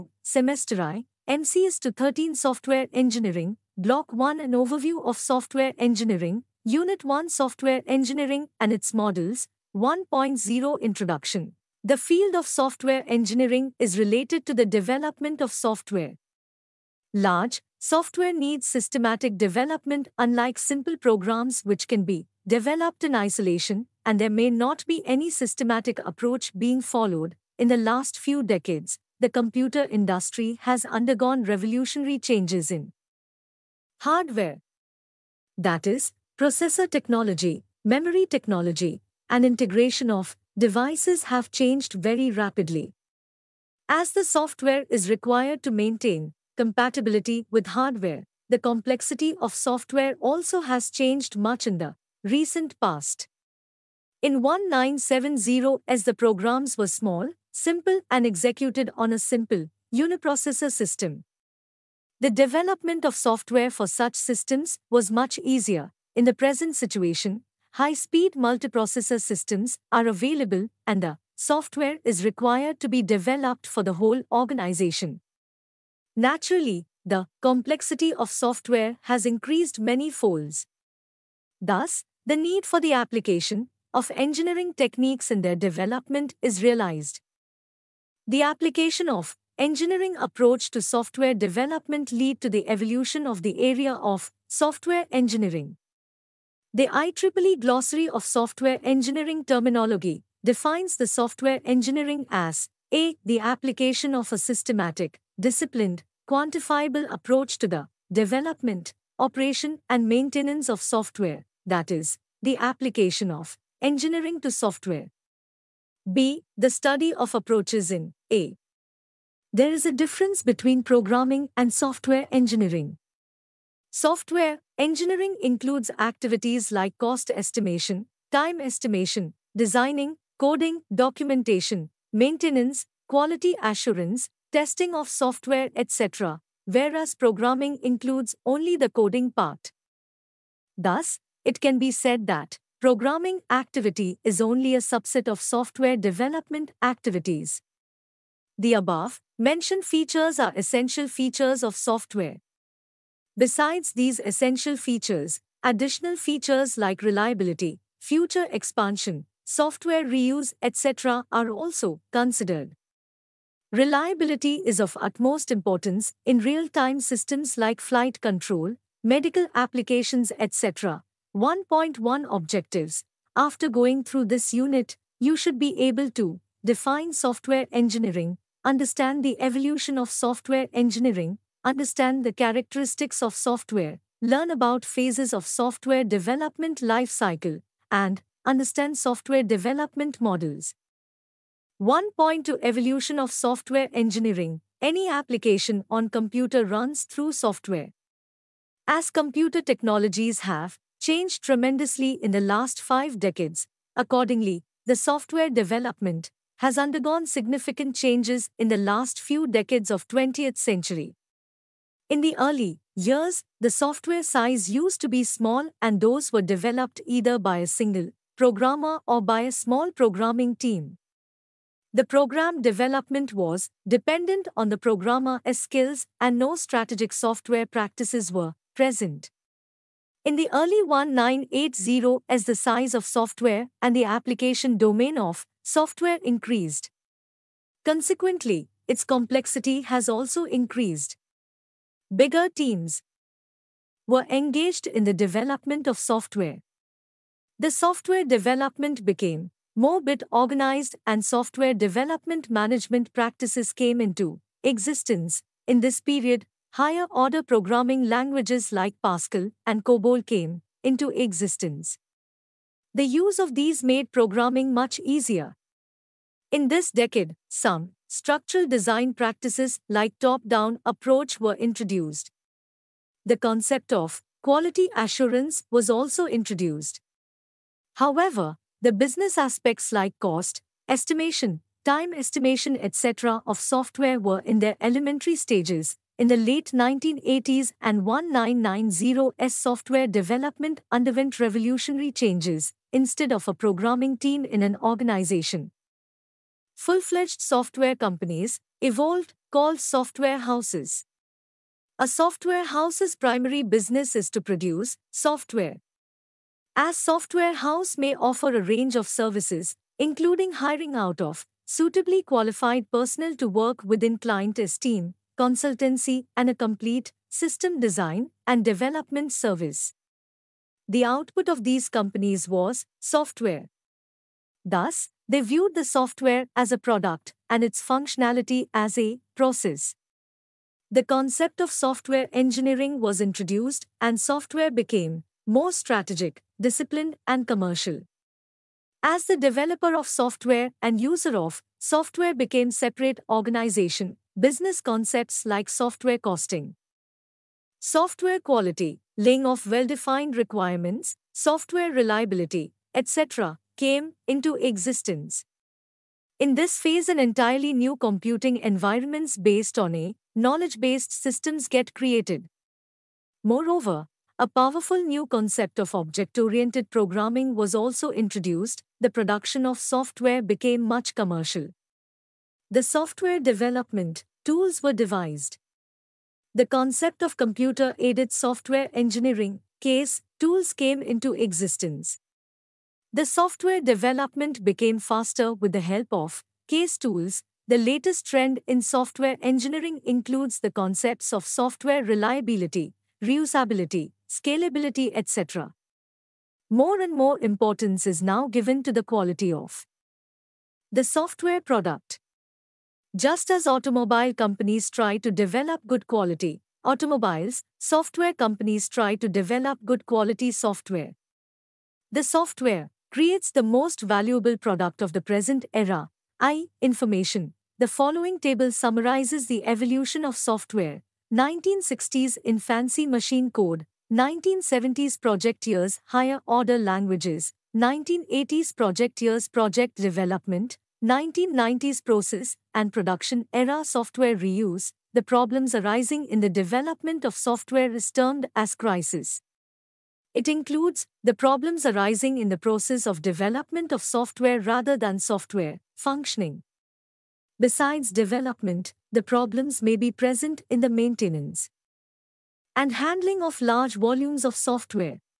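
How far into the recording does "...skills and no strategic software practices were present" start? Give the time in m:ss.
3:45.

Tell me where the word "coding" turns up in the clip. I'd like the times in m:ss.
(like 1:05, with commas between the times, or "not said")
2:10, 2:18.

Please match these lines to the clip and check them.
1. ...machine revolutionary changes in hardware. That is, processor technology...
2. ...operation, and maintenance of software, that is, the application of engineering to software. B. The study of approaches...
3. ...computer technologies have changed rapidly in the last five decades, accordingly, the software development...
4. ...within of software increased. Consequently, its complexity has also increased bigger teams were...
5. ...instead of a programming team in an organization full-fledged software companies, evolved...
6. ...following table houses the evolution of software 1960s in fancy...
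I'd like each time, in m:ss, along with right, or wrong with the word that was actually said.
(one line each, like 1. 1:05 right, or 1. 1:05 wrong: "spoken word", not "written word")
1. 0:30 wrong: "undergone", not "machine"
2. 1:49 right
3. 3:19 wrong: "tremendously", not "rapidly"
4. 3:54 wrong: "domain", not "within"
5. 4:52 right
6. 6:57 wrong: "summarizes", not "houses".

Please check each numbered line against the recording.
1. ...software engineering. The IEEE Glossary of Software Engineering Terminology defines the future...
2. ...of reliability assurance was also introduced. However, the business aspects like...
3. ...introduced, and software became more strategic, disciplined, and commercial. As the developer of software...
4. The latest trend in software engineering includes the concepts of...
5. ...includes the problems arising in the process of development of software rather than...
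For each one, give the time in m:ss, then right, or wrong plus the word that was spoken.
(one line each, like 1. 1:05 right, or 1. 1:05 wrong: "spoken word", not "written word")
1. 1:34 wrong: "software", not "future"
2. 4:33 wrong: "quality", not "reliability"
3. 5:33 right
4. 6:27 right
5. 7:20 right.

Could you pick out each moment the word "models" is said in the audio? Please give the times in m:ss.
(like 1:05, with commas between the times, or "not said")
0:08, 3:10.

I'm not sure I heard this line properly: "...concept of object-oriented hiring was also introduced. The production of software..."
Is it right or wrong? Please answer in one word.
wrong.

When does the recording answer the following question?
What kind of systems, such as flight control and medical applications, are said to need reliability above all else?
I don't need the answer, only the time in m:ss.
2:46.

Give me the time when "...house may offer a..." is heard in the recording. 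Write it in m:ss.
5:07.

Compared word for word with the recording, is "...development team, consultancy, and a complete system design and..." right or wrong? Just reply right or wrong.
wrong.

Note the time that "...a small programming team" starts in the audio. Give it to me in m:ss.
3:39.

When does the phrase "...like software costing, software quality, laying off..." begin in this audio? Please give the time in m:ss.
5:45.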